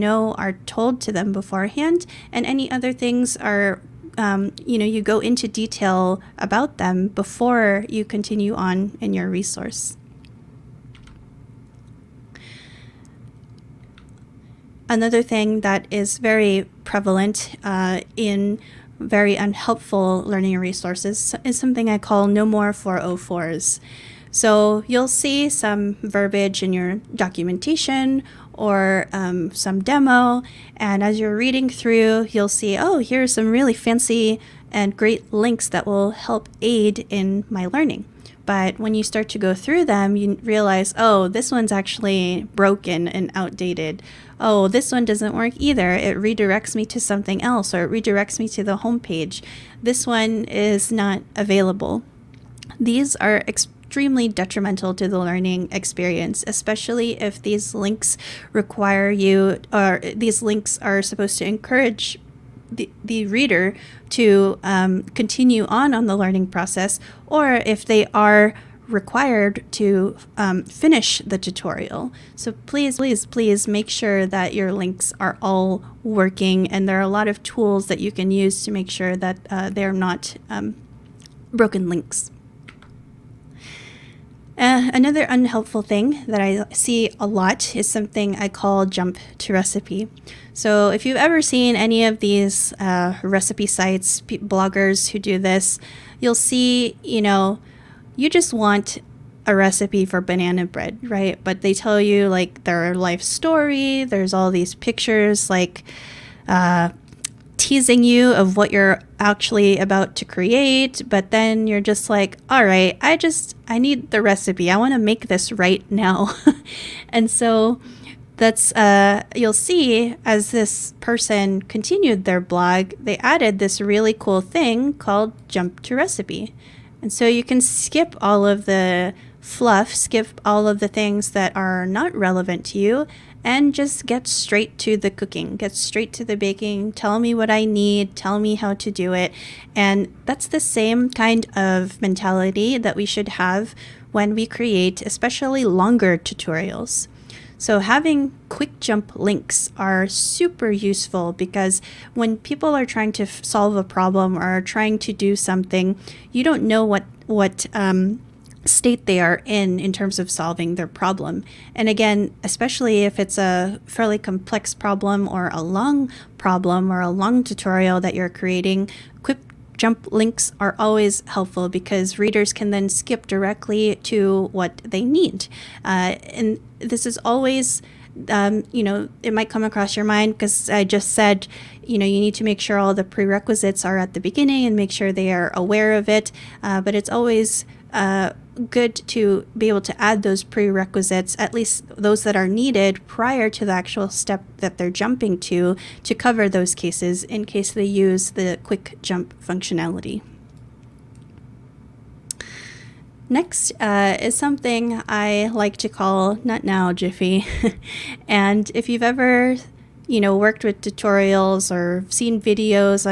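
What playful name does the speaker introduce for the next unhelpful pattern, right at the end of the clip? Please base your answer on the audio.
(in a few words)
Not Now Jiffy.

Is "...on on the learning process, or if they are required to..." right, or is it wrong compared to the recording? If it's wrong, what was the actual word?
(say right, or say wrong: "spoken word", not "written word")
right.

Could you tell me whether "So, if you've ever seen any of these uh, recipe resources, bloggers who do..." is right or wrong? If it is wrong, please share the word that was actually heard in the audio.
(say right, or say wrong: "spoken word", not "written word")
wrong: "sites", not "resources".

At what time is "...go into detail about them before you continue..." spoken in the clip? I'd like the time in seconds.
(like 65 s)
5 s.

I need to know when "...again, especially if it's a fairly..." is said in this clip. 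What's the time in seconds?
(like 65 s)
161 s.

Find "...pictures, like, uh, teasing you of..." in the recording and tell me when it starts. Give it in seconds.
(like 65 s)
104 s.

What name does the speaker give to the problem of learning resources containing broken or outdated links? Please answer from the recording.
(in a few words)
No more 404s.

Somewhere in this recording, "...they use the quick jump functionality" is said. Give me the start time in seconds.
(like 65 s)
197 s.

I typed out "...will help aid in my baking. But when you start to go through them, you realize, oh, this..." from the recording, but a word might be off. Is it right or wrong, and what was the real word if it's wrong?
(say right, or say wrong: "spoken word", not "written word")
wrong: "learning", not "baking".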